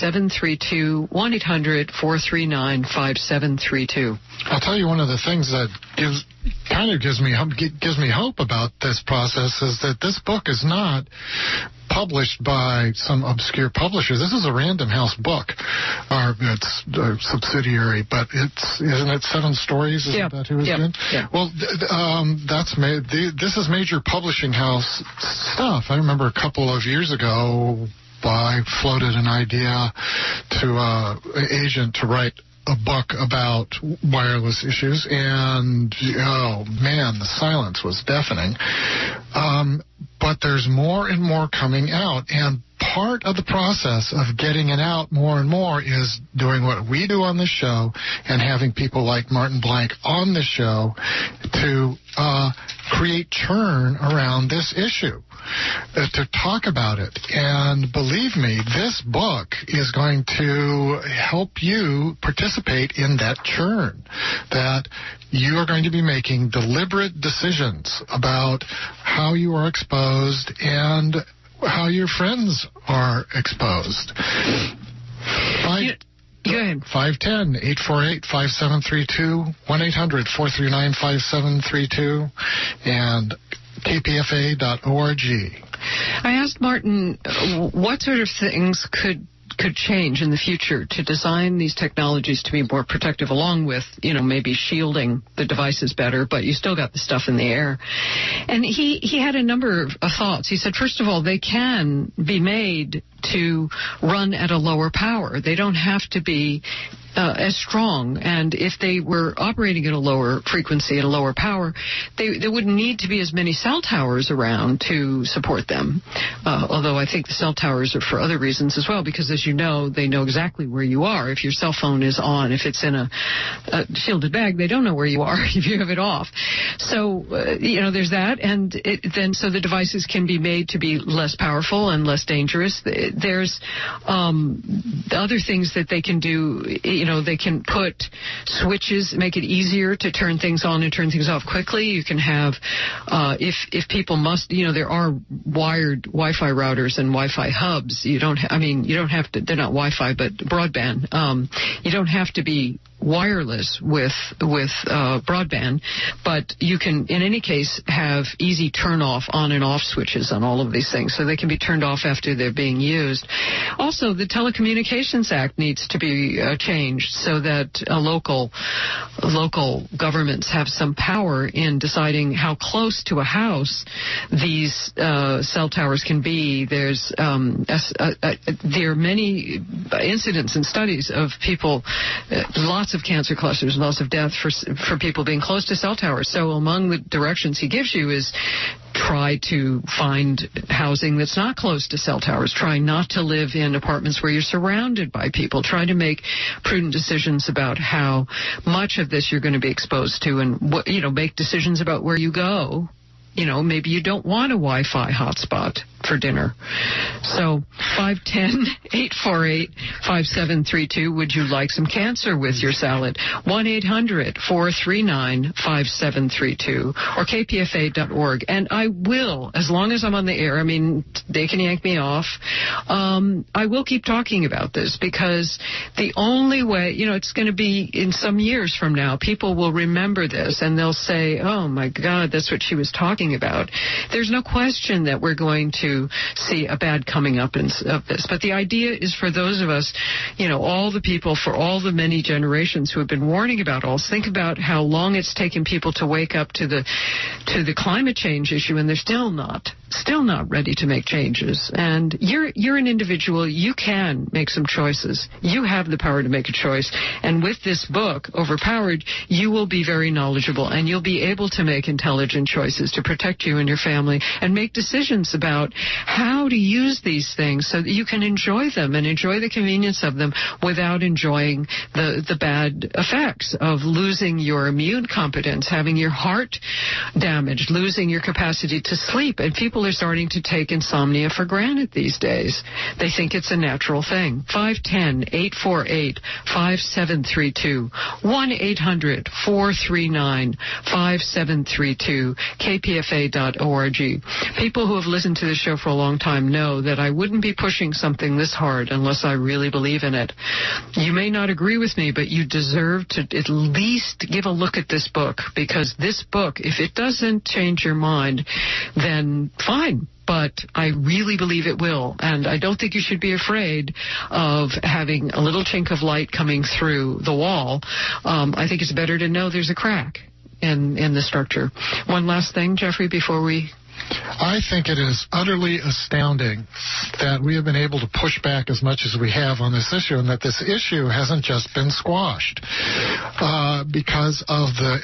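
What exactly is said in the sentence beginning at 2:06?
So, uh, you know, there's that.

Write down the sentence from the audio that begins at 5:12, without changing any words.
And I don't think you should be afraid of having a little chink of light coming through the wall.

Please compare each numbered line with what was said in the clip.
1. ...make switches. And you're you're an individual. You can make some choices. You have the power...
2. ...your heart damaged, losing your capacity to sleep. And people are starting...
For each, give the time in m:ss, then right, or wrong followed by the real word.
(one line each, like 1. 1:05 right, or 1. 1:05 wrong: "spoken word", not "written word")
1. 4:10 wrong: "changes", not "switches"
2. 4:35 right.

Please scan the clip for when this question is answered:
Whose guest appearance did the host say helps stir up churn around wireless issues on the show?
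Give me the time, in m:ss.
0:49.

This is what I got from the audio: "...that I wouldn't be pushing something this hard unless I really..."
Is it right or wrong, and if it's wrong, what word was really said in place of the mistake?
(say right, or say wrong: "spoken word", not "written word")
right.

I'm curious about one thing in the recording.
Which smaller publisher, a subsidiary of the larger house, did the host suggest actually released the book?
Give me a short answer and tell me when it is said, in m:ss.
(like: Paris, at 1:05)
Seven Stories, at 0:19.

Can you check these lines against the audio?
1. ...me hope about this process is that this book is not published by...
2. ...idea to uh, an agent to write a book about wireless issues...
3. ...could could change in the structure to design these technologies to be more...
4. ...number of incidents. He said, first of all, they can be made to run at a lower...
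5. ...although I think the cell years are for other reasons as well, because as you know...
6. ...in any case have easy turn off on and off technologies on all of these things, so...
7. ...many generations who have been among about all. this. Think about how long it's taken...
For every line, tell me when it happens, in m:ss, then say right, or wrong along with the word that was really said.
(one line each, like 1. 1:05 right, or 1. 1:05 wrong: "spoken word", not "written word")
1. 0:07 right
2. 0:29 right
3. 1:28 wrong: "future", not "structure"
4. 1:39 wrong: "thoughts", not "incidents"
5. 1:56 wrong: "towers", not "years"
6. 2:37 wrong: "switches", not "technologies"
7. 4:01 wrong: "warning", not "among".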